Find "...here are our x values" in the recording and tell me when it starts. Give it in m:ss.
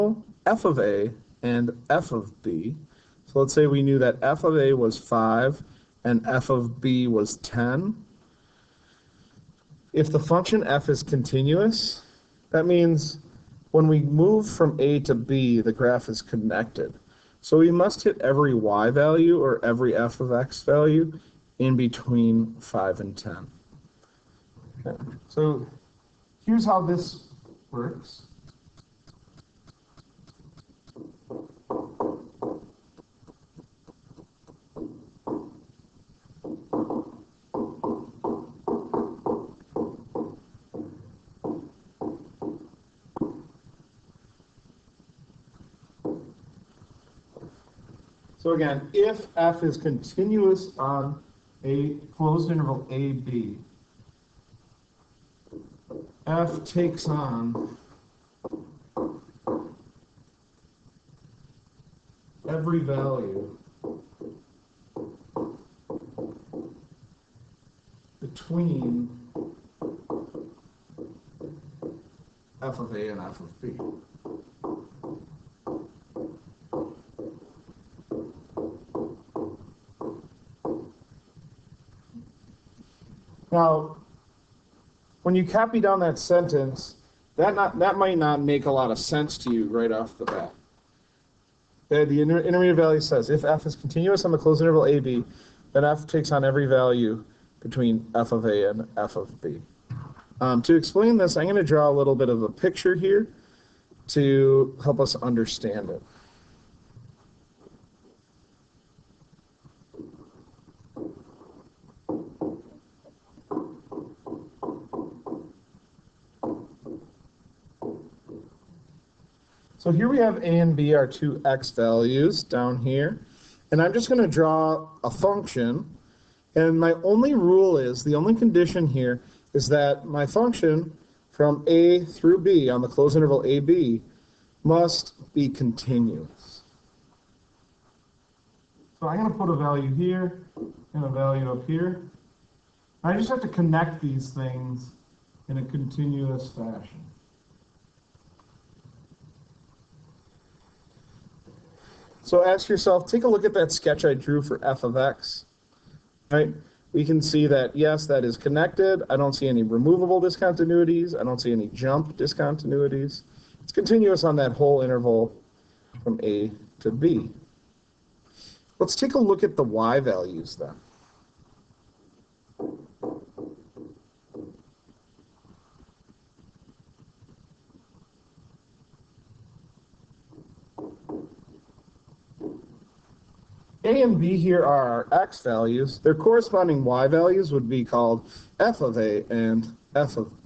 3:04.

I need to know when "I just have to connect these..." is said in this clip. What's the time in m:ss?
2:23.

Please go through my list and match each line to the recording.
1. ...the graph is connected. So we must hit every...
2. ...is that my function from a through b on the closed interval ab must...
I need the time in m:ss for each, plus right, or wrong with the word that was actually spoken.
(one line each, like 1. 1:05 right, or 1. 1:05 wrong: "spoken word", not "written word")
1. 0:15 right
2. 2:09 right.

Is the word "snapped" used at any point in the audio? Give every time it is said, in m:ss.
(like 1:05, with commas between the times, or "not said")
not said.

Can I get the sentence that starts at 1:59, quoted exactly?
So here we have a and b, our two x values down here.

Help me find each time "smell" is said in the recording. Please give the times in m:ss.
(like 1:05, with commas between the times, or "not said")
not said.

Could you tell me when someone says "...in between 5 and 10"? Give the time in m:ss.
0:21.